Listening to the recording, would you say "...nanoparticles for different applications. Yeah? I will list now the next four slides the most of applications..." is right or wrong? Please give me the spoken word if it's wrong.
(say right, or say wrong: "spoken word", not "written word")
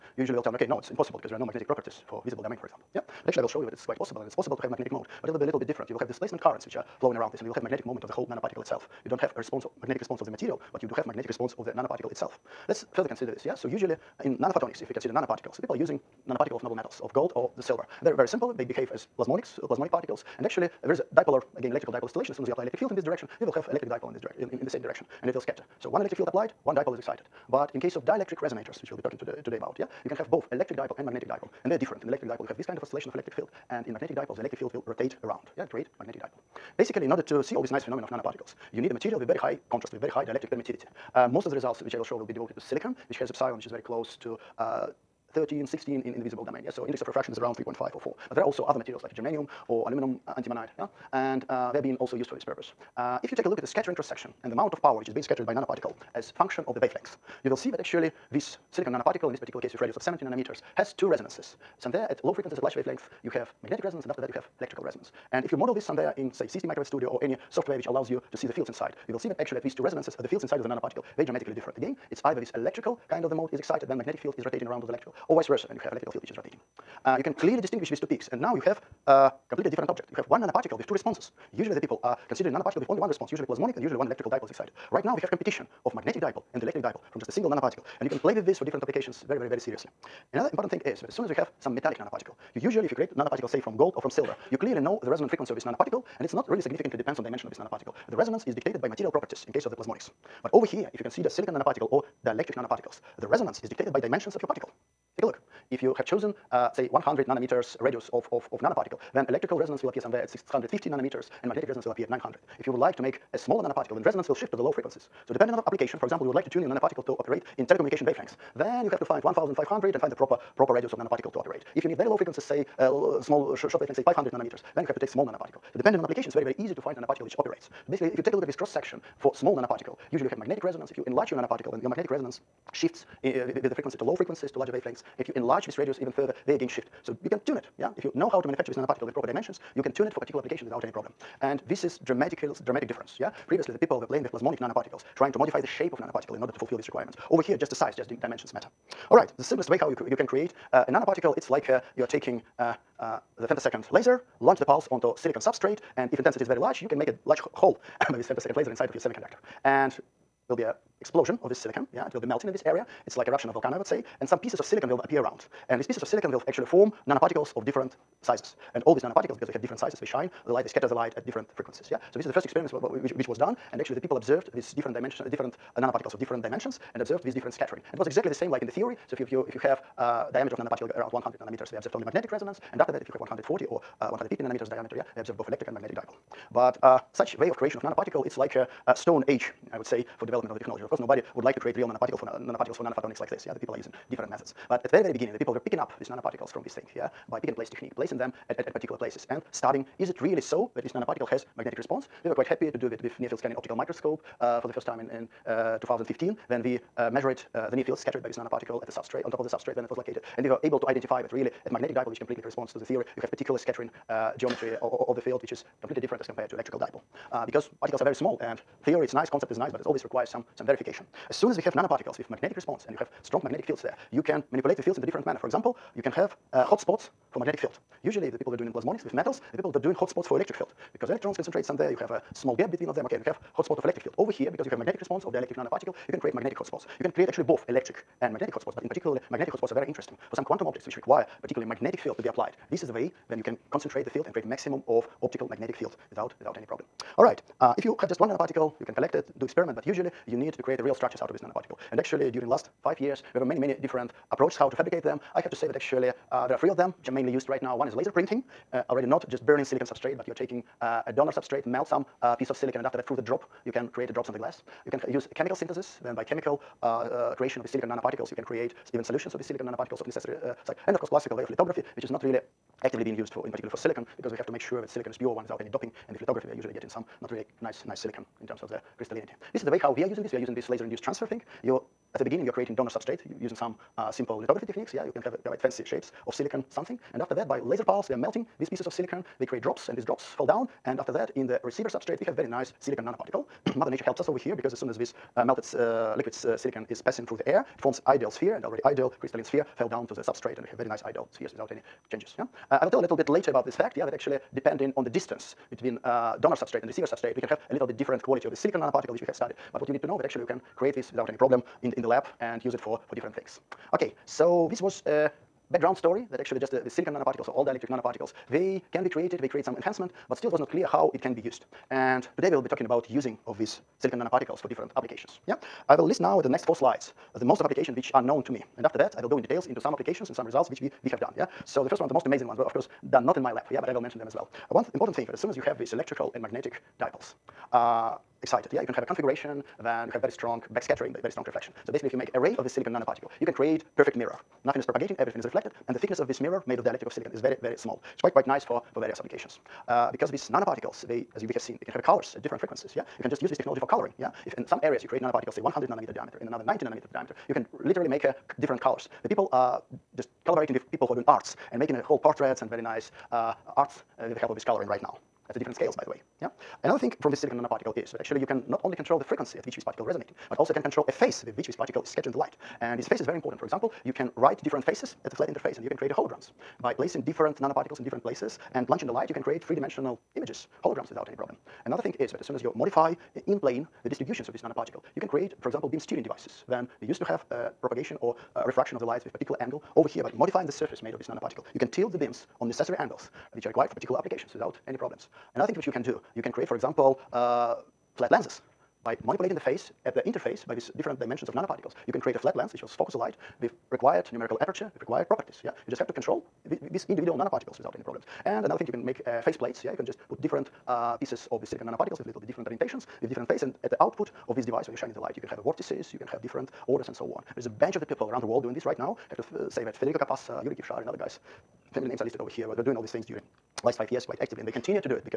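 right.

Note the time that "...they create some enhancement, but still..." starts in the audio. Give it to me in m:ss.
5:19.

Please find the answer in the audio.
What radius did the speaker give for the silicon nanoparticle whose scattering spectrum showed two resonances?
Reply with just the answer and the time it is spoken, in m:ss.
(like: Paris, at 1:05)
70 nanometers, at 1:00.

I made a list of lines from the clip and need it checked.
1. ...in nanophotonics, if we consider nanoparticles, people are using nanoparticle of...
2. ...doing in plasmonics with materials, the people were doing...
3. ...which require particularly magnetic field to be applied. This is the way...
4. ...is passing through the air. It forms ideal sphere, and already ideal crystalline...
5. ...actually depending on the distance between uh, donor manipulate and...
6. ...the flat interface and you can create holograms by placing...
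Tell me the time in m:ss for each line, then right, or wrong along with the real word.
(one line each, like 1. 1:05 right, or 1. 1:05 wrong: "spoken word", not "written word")
1. 0:14 right
2. 3:48 wrong: "metals", not "materials"
3. 4:00 right
4. 4:56 right
5. 5:04 wrong: "substrate", not "manipulate"
6. 6:15 right.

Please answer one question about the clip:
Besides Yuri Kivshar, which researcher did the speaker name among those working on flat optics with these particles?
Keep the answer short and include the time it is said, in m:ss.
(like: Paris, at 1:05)
Federico Capasso, at 6:59.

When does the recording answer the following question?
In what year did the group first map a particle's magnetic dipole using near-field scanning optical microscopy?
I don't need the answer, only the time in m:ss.
3:25.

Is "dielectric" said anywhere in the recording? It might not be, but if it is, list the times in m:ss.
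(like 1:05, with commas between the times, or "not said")
0:28, 0:40, 1:42, 3:55, 5:17, 5:46.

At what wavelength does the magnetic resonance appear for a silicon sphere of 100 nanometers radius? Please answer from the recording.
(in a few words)
900.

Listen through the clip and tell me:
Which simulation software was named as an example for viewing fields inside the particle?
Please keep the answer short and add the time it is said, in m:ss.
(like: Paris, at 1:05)
CST Microwave Studio, at 1:06.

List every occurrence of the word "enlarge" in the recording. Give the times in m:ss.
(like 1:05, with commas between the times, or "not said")
2:11, 2:15.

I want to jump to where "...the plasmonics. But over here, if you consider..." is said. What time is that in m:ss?
1:39.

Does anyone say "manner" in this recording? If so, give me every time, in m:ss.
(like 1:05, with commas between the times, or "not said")
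3:45.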